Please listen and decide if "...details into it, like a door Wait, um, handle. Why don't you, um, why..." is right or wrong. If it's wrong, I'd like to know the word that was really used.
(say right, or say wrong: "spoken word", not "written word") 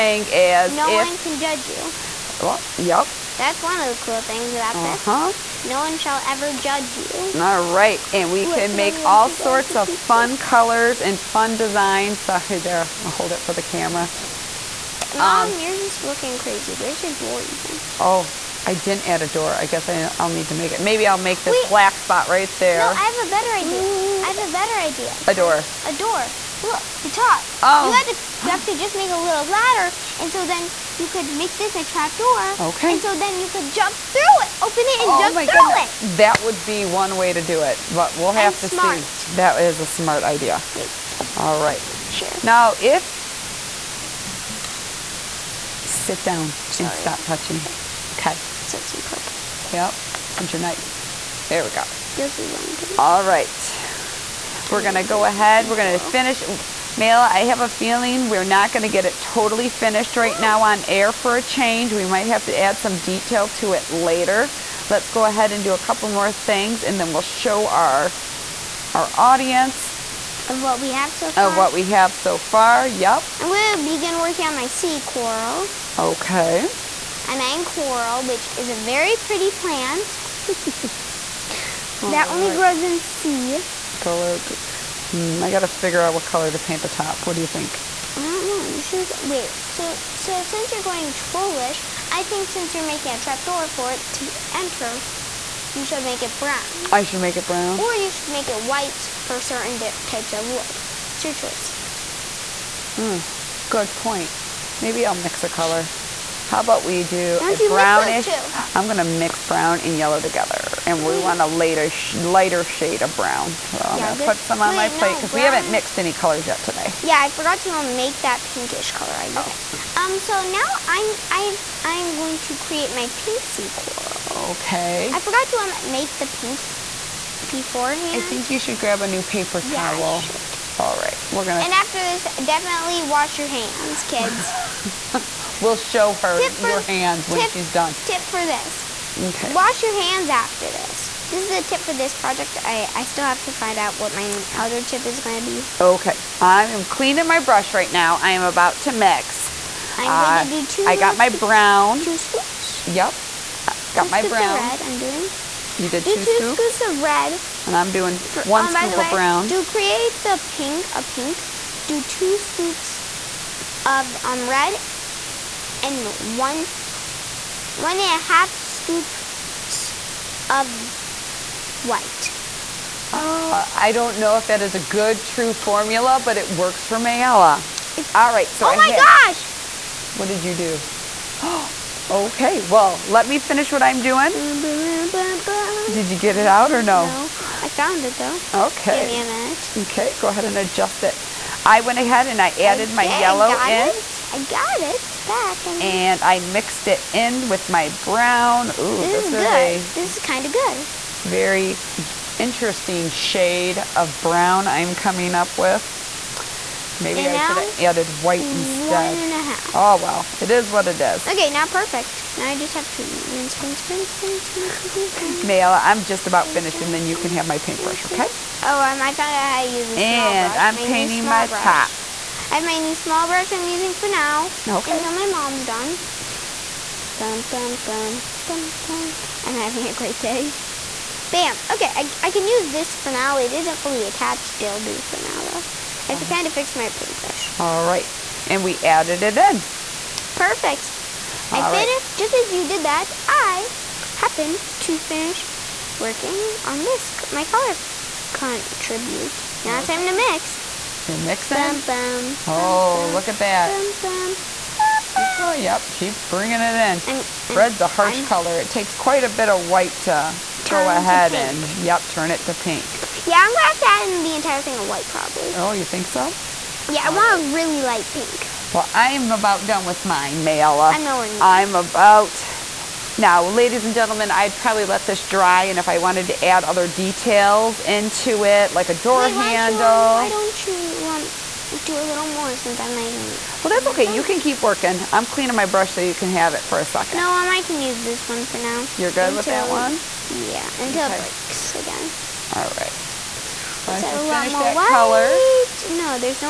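right.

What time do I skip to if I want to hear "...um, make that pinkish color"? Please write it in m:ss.
1:57.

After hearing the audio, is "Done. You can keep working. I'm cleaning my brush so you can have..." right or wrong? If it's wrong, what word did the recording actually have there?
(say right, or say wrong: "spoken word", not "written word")
right.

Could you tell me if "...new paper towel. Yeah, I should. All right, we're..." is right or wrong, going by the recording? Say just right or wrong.
right.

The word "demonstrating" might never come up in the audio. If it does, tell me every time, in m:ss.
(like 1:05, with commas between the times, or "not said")
not said.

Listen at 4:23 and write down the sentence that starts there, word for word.
Yeah, I'm gonna have to add in the entire thing of white probably.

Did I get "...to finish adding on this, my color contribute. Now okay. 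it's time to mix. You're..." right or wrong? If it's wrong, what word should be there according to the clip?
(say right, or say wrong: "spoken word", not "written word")
wrong: "working", not "adding".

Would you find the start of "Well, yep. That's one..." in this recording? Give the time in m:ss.
0:02.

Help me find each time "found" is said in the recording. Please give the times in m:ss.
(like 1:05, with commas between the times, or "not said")
3:07, 3:39.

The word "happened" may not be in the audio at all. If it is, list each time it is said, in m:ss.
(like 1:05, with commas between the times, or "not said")
4:04.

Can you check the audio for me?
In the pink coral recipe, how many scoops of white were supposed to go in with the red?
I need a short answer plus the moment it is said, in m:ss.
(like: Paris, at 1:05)
1.5, at 2:47.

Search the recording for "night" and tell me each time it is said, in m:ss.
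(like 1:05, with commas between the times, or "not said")
0:50.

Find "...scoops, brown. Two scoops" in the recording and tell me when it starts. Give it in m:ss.
2:31.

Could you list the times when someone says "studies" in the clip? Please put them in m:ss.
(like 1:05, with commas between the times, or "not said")
not said.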